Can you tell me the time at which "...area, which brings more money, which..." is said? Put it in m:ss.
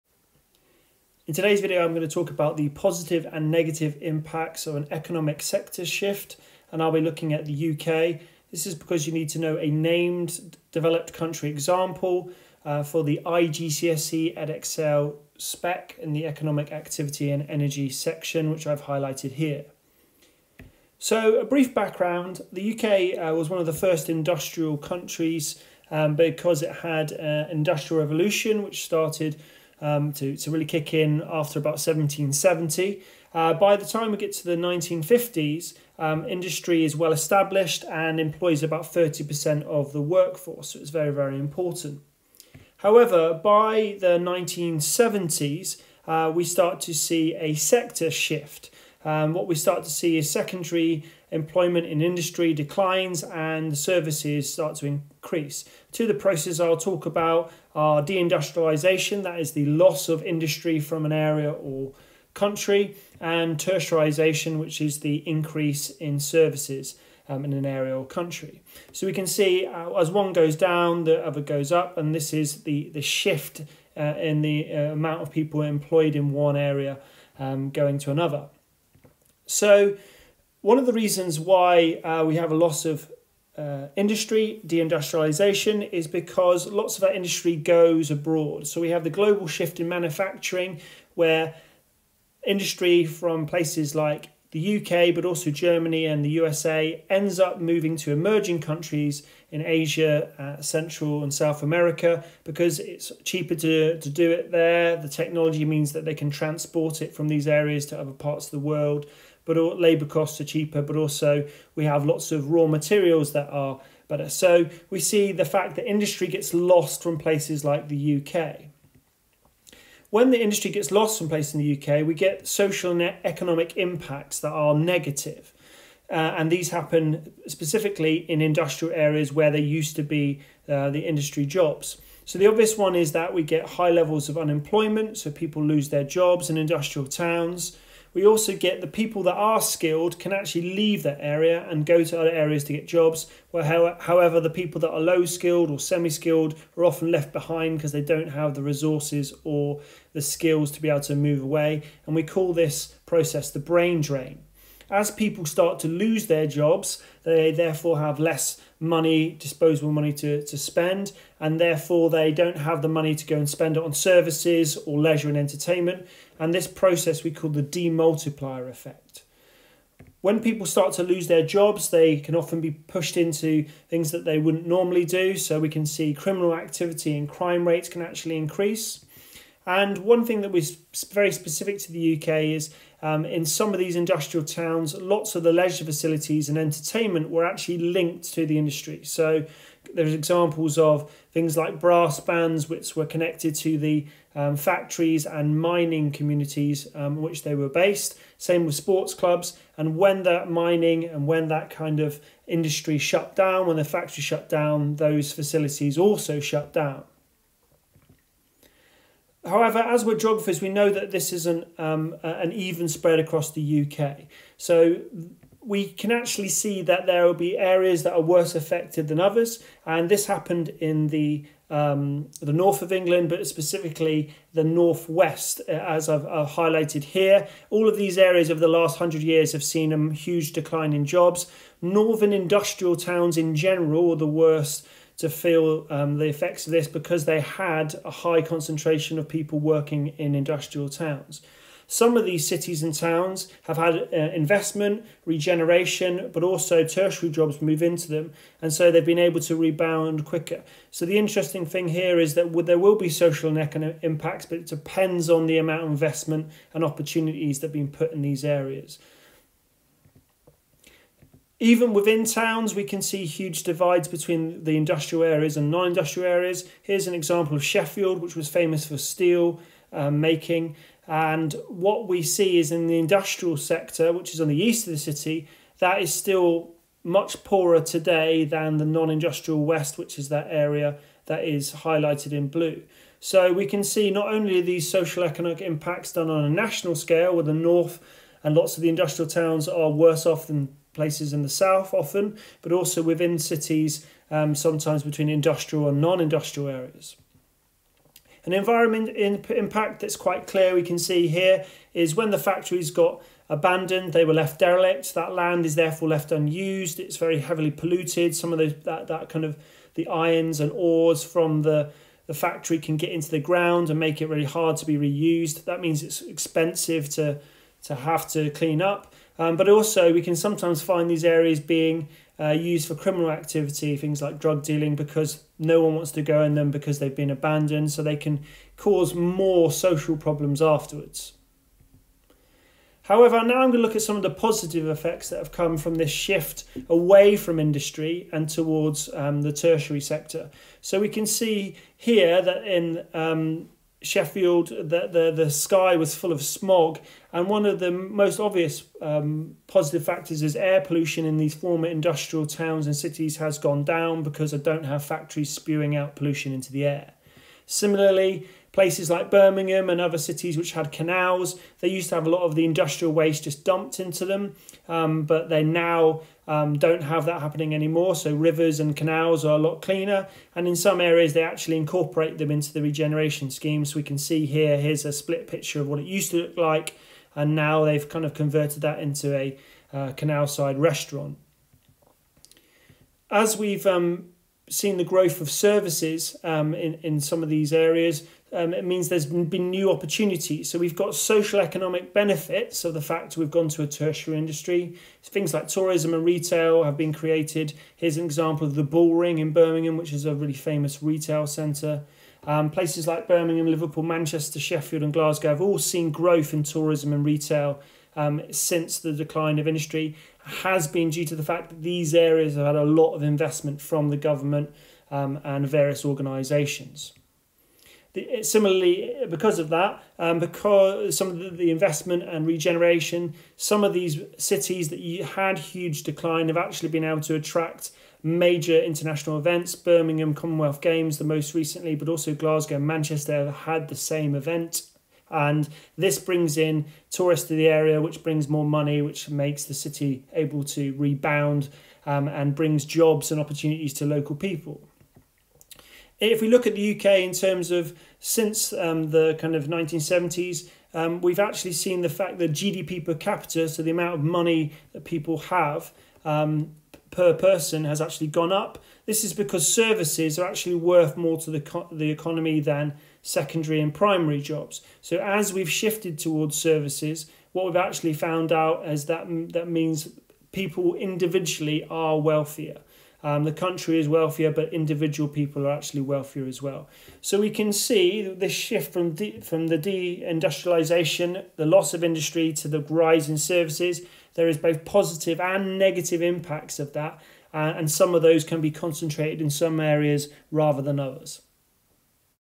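7:17.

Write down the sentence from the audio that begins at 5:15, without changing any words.
That means it's expensive to to have to clean up.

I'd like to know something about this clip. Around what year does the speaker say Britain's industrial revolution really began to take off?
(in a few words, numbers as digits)
1770.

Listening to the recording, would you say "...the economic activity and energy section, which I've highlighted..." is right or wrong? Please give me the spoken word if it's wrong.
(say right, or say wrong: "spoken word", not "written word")
right.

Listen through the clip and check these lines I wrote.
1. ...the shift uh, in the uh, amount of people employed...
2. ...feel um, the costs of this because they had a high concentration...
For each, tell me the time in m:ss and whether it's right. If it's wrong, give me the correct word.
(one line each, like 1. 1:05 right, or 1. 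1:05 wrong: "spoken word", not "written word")
1. 1:12 right
2. 3:55 wrong: "effects", not "costs".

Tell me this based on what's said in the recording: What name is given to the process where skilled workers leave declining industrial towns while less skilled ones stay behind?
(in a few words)
brain drain.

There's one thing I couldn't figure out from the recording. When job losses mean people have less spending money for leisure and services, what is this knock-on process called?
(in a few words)
demultiplier effect.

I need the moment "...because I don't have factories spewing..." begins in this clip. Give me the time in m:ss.
5:54.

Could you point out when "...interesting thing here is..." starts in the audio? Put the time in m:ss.
4:11.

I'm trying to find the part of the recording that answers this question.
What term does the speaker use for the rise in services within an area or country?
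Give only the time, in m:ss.
1:03.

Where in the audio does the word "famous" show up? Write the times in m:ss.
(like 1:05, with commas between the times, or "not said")
4:28, 6:40.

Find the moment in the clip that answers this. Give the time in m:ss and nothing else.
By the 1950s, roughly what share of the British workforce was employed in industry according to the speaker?
0:38.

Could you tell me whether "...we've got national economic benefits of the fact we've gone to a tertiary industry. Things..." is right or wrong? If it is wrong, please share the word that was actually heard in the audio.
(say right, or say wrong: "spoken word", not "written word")
wrong: "social", not "national".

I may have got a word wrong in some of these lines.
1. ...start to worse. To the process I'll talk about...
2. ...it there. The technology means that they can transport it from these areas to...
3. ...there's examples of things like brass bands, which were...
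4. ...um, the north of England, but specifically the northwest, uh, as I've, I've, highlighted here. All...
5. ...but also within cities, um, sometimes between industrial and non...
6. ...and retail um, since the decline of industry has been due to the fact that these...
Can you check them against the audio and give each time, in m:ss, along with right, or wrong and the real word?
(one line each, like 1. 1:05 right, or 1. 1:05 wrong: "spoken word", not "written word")
1. 0:54 wrong: "increase", not "worse"
2. 1:44 right
3. 3:09 right
4. 3:41 right
5. 4:52 right
6. 6:47 right.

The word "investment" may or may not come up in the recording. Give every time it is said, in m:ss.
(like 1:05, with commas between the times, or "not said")
4:04, 4:15, 6:53, 7:01.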